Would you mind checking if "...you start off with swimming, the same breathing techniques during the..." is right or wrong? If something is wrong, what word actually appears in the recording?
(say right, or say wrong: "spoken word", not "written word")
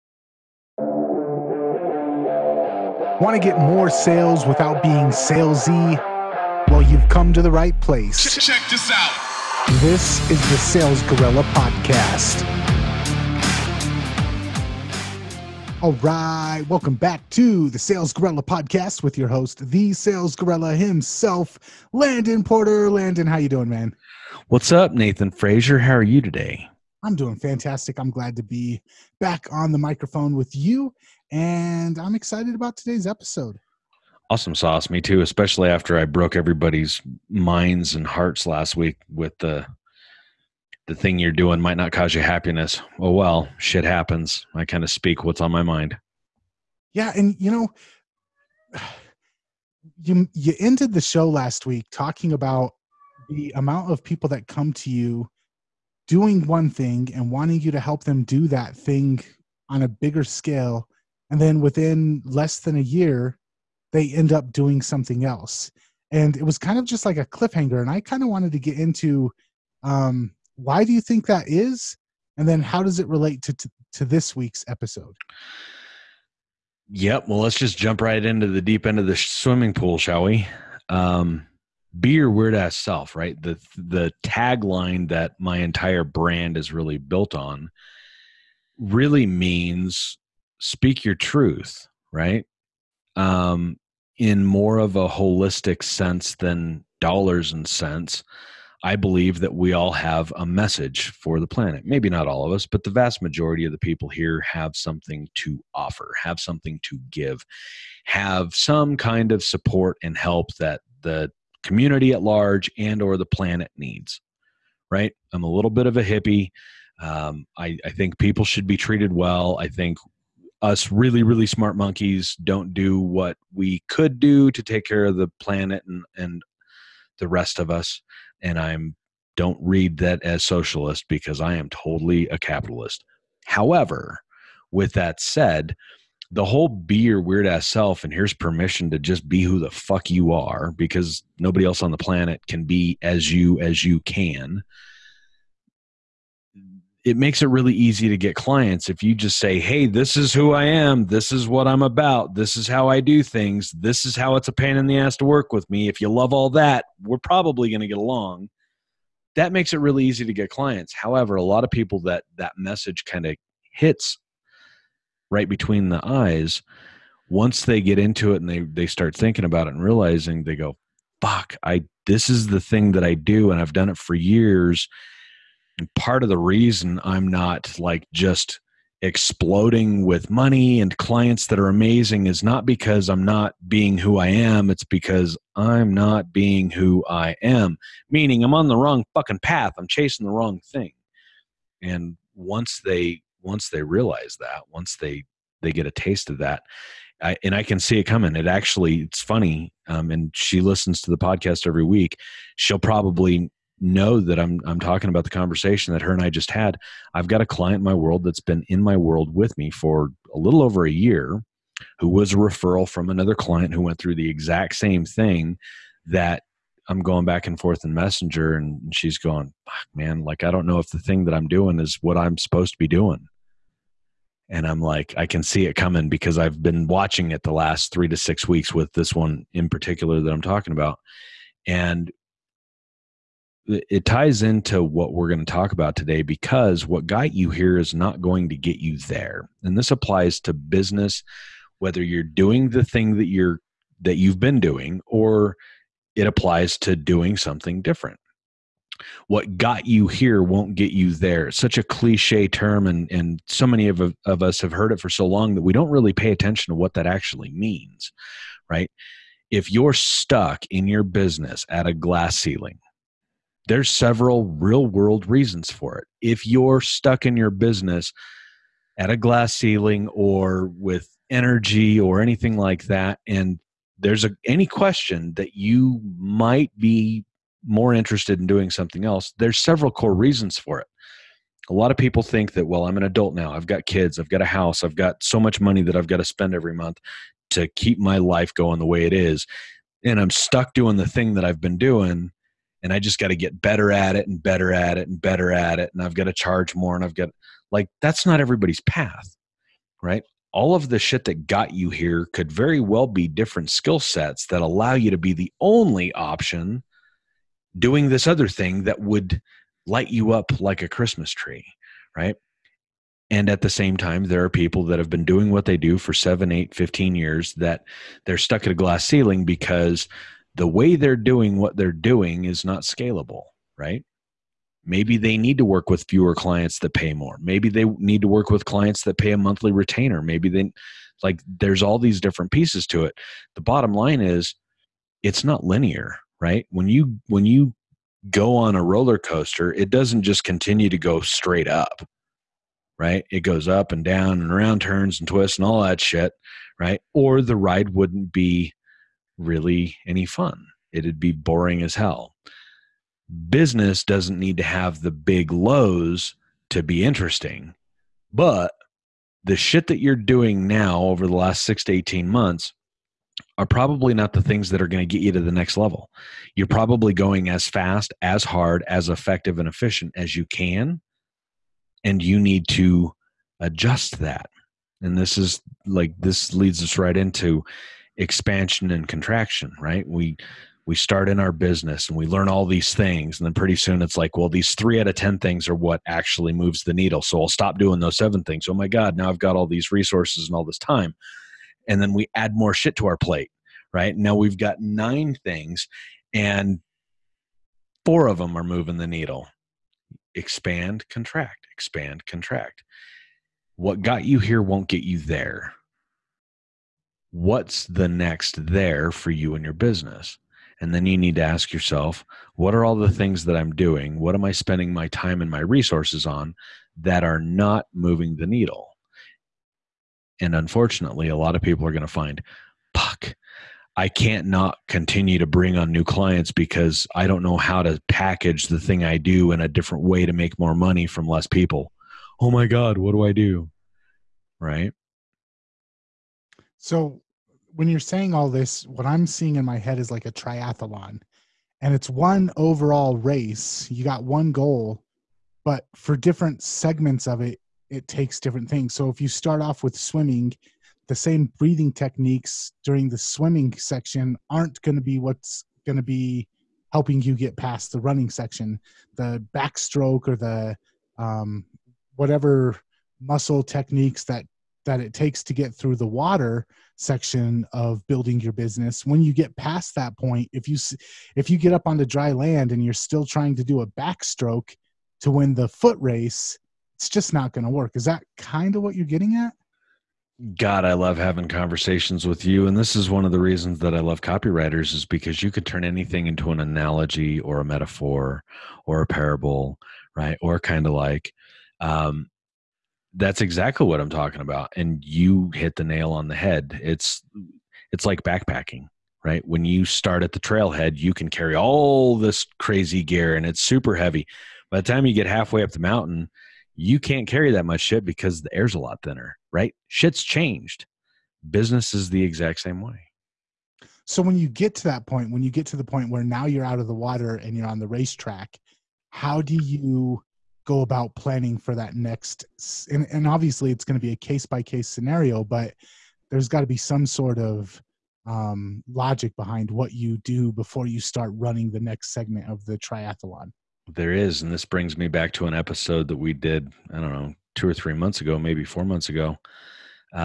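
right.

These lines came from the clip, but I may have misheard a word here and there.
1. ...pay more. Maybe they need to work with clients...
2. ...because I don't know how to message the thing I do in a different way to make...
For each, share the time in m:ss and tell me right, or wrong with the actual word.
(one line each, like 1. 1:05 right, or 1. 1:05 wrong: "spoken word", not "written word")
1. 5:26 right
2. 7:06 wrong: "package", not "message".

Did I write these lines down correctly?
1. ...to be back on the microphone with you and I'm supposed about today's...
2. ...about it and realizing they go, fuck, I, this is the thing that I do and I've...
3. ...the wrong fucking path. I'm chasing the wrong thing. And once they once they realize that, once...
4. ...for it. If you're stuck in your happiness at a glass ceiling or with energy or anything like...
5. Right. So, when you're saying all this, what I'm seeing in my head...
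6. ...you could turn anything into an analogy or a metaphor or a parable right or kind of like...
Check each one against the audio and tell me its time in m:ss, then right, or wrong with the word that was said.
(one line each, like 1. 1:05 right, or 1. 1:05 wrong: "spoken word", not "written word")
1. 0:28 wrong: "excited", not "supposed"
2. 2:49 right
3. 3:08 right
4. 4:25 wrong: "business", not "happiness"
5. 7:14 right
6. 8:05 right.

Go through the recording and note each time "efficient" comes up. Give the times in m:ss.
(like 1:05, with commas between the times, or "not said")
6:09.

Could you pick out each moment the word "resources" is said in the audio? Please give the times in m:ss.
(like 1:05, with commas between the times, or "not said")
6:29, 6:55.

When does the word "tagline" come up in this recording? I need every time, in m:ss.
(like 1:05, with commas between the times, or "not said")
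1:24.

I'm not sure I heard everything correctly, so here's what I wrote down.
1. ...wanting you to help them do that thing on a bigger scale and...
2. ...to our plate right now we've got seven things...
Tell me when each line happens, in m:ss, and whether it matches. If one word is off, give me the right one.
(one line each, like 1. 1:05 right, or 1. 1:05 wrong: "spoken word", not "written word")
1. 0:57 right
2. 6:32 wrong: "nine", not "seven".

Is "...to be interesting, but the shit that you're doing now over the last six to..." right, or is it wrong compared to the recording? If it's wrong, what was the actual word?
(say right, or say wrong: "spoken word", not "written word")
right.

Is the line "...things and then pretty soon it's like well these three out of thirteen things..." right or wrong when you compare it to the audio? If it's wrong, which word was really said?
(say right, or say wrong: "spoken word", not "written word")
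wrong: "ten", not "thirteen".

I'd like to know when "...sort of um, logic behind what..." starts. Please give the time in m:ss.
8:47.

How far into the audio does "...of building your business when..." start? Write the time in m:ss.
7:47.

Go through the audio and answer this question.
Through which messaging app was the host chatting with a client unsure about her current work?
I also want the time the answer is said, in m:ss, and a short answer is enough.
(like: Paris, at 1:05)
Messenger, at 3:37.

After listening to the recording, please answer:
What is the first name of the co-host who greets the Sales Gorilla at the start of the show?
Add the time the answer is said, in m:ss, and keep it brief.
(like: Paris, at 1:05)
Nathan, at 0:24.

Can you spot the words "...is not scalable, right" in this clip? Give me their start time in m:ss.
5:22.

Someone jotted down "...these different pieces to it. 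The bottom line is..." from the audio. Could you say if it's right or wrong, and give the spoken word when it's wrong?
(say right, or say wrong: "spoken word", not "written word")
right.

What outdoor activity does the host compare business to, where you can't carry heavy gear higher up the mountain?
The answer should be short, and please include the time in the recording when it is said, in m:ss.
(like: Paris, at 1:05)
backpacking, at 8:18.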